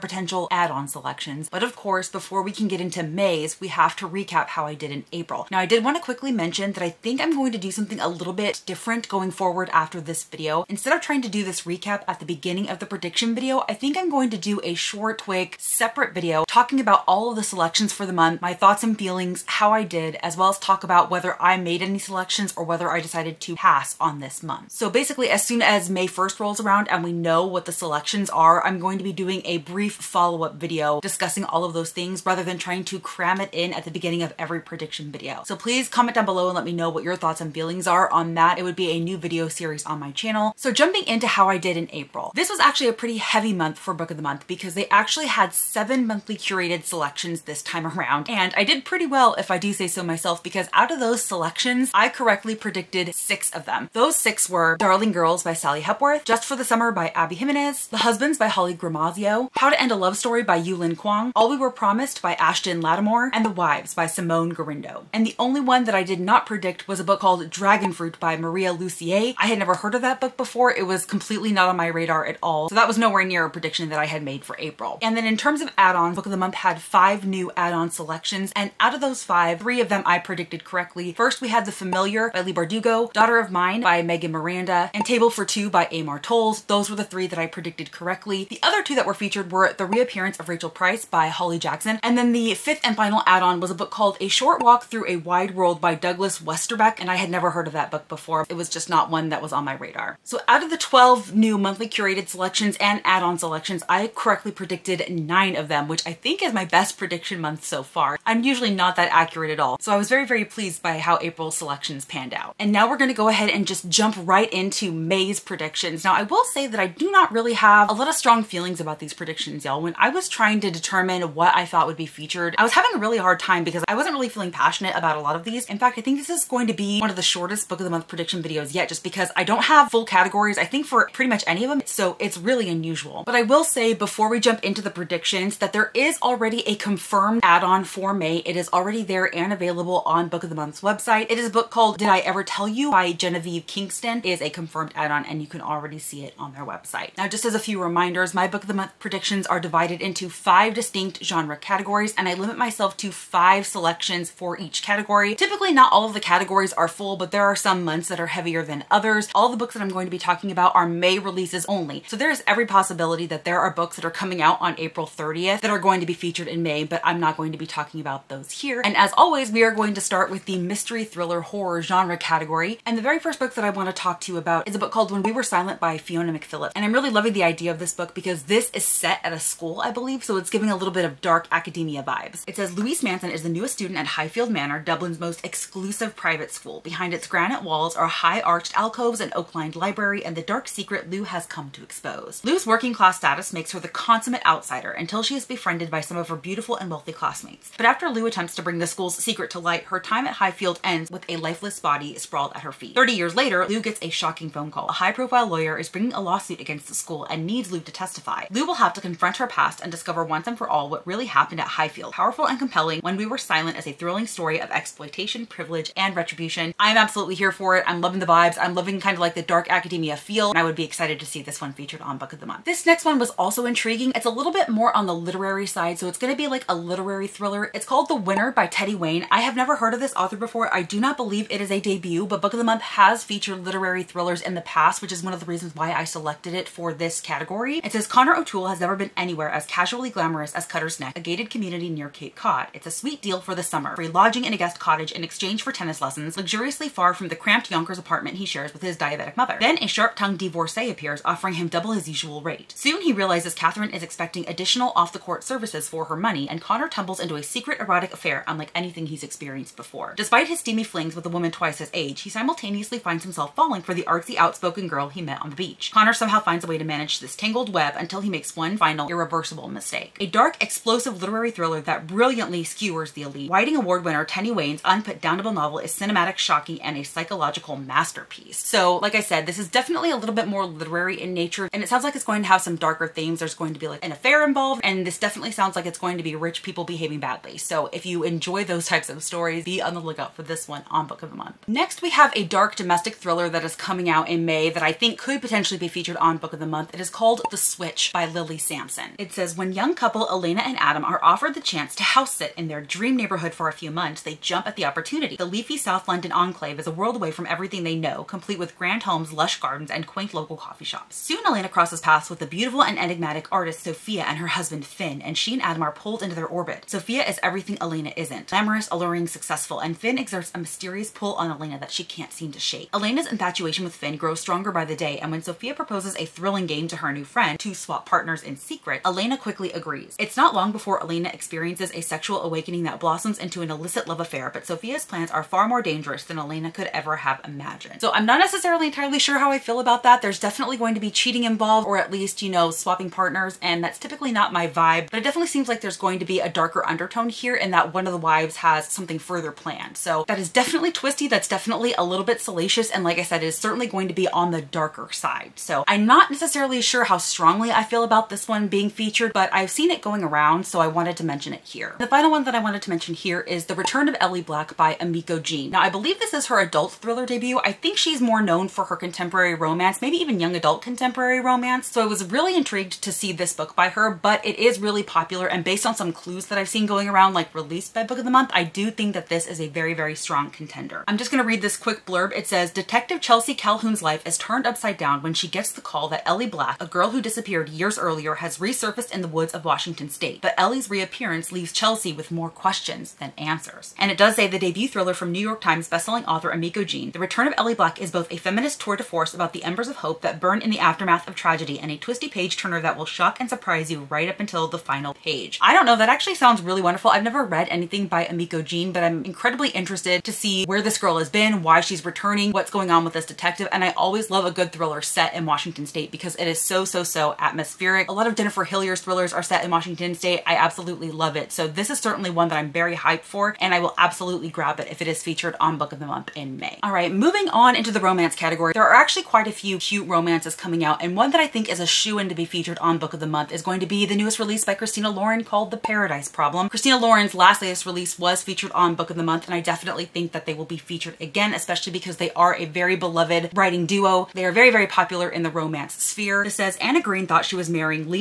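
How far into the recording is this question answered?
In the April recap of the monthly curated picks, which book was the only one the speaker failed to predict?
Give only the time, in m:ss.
1:07.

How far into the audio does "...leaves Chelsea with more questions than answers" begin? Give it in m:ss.
6:31.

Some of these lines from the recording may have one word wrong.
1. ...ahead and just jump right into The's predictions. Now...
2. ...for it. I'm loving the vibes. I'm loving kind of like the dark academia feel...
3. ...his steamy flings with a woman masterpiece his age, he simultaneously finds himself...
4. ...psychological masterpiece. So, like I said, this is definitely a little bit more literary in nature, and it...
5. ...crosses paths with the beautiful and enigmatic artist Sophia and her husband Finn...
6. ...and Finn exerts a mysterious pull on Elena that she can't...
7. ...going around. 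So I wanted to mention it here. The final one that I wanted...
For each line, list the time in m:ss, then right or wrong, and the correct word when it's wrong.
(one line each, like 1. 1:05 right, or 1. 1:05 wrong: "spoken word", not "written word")
1. 1:53 wrong: "May", not "The"
2. 3:37 right
3. 4:20 wrong: "twice", not "masterpiece"
4. 4:37 right
5. 5:11 right
6. 5:19 right
7. 6:00 right.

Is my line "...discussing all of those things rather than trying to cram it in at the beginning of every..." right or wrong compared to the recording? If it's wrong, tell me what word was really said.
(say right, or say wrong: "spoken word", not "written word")
right.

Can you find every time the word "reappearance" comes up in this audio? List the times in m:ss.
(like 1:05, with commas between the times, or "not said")
1:29, 6:30.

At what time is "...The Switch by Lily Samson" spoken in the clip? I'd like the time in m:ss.
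4:57.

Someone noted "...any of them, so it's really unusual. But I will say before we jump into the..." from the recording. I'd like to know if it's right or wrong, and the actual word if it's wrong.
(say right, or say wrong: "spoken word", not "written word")
right.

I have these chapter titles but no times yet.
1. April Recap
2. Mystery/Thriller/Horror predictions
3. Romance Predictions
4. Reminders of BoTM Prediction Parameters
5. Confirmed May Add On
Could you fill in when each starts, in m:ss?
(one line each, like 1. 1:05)
1. 0:40
2. 2:48
3. 7:07
4. 2:27
5. 2:13.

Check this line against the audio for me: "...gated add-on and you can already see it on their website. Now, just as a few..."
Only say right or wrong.
wrong.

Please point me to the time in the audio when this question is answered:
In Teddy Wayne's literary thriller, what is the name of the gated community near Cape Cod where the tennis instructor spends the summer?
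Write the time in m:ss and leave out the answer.
4:00.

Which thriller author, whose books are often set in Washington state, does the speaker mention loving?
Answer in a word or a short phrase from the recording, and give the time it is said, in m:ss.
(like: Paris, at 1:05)
Jennifer Hillier, at 6:58.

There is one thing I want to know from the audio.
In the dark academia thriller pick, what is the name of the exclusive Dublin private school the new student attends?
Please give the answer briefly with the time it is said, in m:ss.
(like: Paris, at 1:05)
Highfield Manor, at 3:04.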